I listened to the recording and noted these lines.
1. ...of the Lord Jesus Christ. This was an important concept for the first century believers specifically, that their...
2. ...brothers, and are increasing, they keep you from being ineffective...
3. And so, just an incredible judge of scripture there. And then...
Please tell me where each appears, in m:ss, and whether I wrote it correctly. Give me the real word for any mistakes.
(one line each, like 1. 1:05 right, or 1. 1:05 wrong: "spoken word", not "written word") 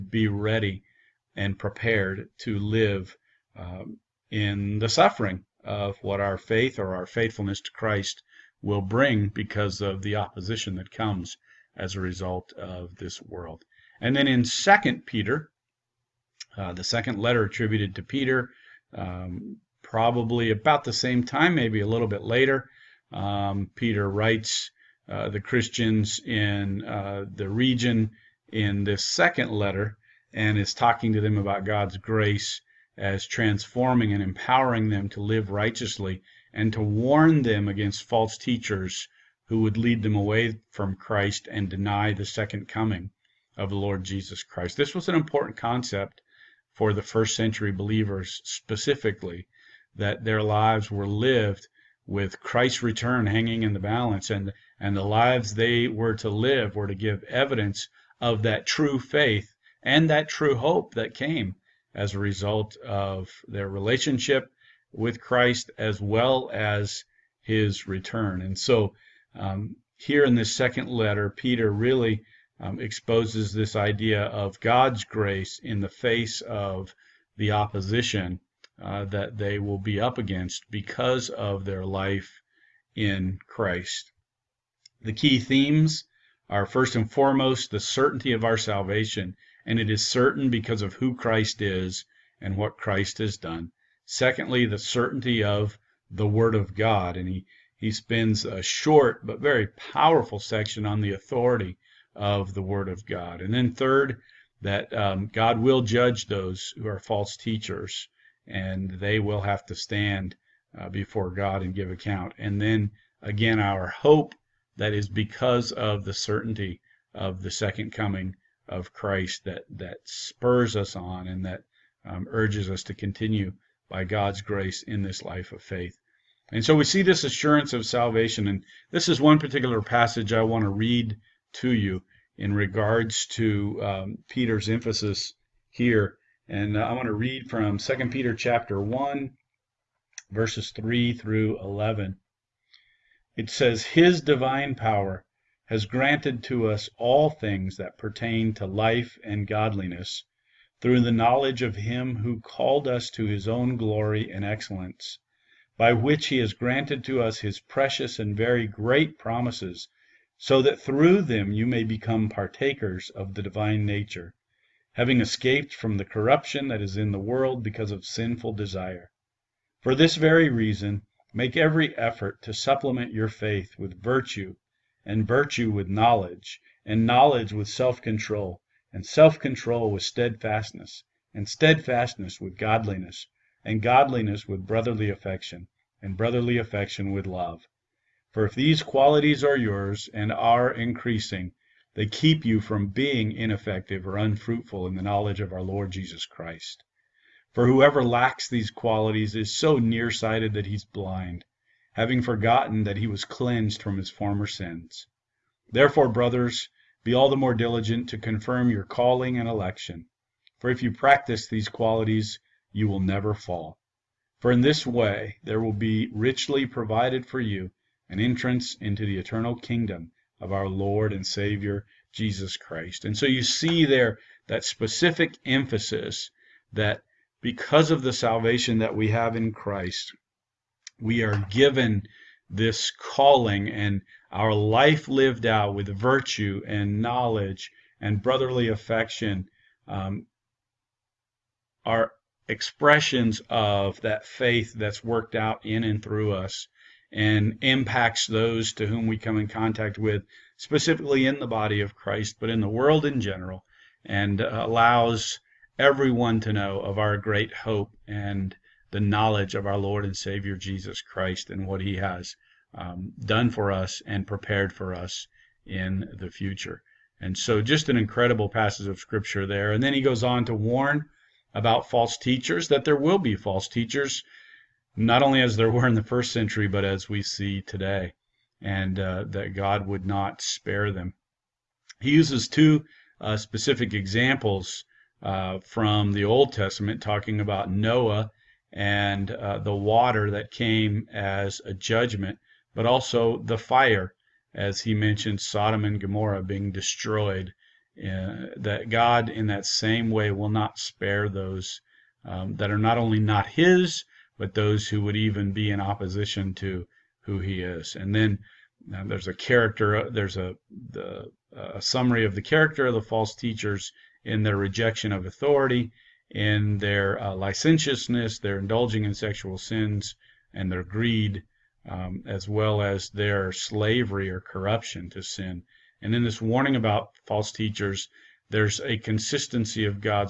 1. 0:43 right
2. 3:09 wrong: "yours", not "brothers"
3. 4:27 wrong: "passage", not "judge".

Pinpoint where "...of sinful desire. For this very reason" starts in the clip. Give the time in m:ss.
2:47.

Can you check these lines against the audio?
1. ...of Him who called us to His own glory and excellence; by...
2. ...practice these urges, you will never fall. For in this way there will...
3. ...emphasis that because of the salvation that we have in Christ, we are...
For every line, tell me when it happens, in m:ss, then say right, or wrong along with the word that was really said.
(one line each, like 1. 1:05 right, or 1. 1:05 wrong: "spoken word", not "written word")
1. 2:31 right
2. 3:30 wrong: "qualities", not "urges"
3. 3:45 right.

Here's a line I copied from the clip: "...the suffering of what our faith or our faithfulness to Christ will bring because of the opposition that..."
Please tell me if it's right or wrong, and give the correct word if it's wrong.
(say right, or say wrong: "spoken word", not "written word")
right.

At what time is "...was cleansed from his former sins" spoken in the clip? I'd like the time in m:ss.
3:23.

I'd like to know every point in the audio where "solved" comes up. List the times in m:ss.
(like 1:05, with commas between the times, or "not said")
not said.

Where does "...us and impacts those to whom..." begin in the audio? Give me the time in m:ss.
4:06.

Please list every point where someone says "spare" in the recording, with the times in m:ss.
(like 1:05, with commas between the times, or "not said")
4:40, 5:00.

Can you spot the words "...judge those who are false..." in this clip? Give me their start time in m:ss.
1:45.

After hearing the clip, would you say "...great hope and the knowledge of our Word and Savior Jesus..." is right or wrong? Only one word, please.
wrong.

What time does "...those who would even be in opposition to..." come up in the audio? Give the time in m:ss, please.
5:04.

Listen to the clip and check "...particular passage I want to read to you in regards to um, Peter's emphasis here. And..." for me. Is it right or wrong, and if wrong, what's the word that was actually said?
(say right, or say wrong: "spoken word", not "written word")
right.